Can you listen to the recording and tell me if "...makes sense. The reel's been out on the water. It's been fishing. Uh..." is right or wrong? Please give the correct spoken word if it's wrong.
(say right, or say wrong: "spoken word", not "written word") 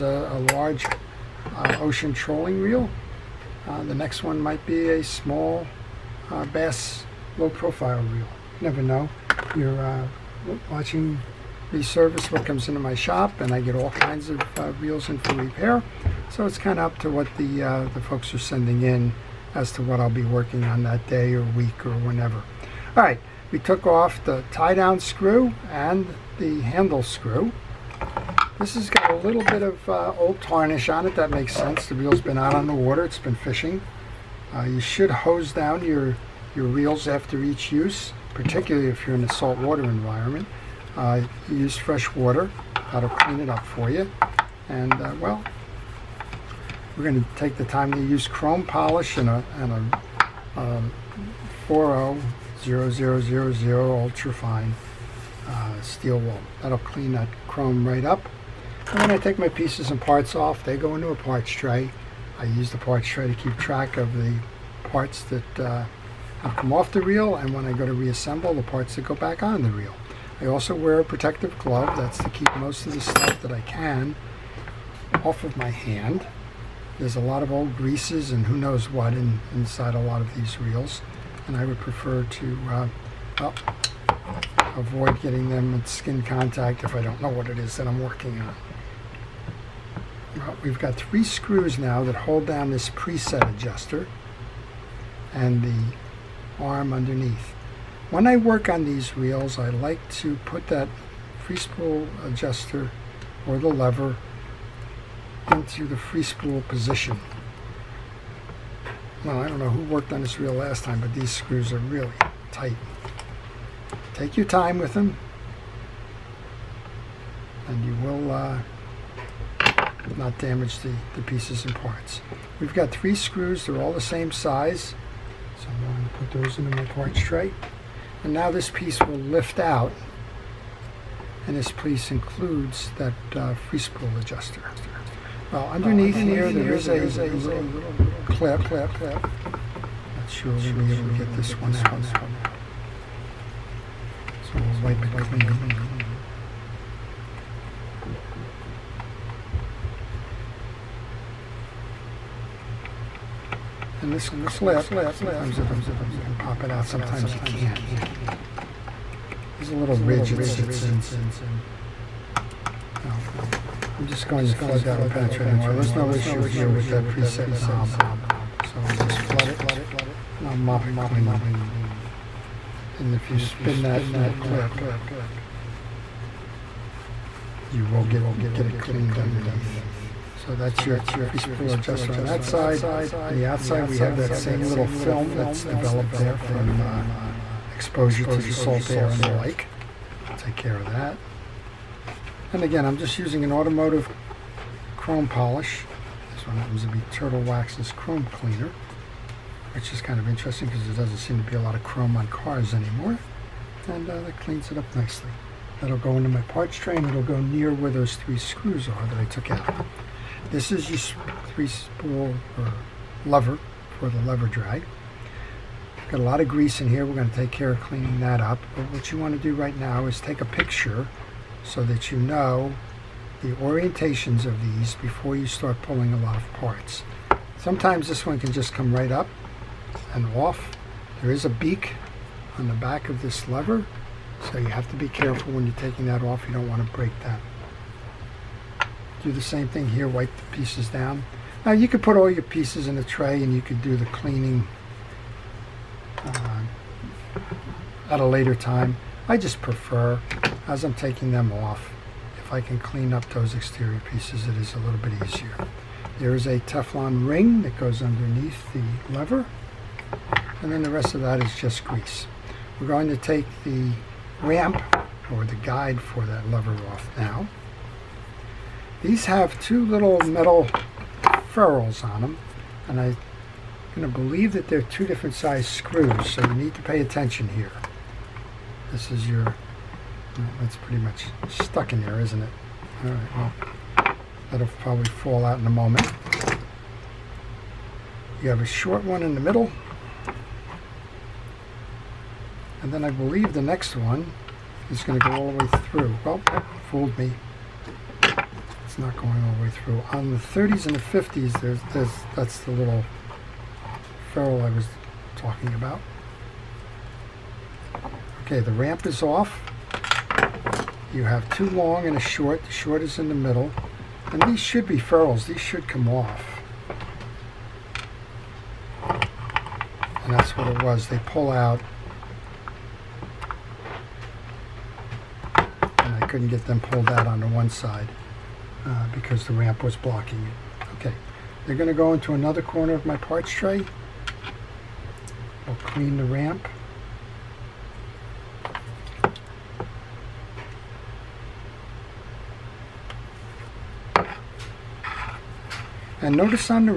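right.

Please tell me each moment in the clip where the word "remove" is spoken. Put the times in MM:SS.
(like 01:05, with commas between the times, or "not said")
not said.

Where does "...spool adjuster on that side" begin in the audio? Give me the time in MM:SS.
03:01.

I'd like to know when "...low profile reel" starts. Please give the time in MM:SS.
00:07.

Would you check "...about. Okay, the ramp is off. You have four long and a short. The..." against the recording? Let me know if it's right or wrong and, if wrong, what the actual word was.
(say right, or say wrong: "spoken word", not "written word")
wrong: "two", not "four".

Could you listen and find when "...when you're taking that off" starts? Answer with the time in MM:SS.
03:55.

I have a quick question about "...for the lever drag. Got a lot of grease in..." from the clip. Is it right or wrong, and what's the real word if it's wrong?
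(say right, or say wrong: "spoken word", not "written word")
right.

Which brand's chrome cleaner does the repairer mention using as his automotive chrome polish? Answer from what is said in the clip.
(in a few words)
Turtle Wax.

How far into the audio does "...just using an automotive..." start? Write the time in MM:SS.
03:12.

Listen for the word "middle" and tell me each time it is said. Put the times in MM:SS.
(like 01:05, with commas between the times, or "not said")
04:49, 05:13.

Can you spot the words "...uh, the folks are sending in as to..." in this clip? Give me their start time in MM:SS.
00:17.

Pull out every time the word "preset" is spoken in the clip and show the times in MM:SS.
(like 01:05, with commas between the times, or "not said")
01:32, 02:47.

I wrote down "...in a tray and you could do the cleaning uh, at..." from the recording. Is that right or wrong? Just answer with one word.
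right.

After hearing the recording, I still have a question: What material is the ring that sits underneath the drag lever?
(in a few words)
Teflon.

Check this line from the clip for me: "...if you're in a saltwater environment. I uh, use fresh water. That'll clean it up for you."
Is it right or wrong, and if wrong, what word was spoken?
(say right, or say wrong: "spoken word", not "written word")
right.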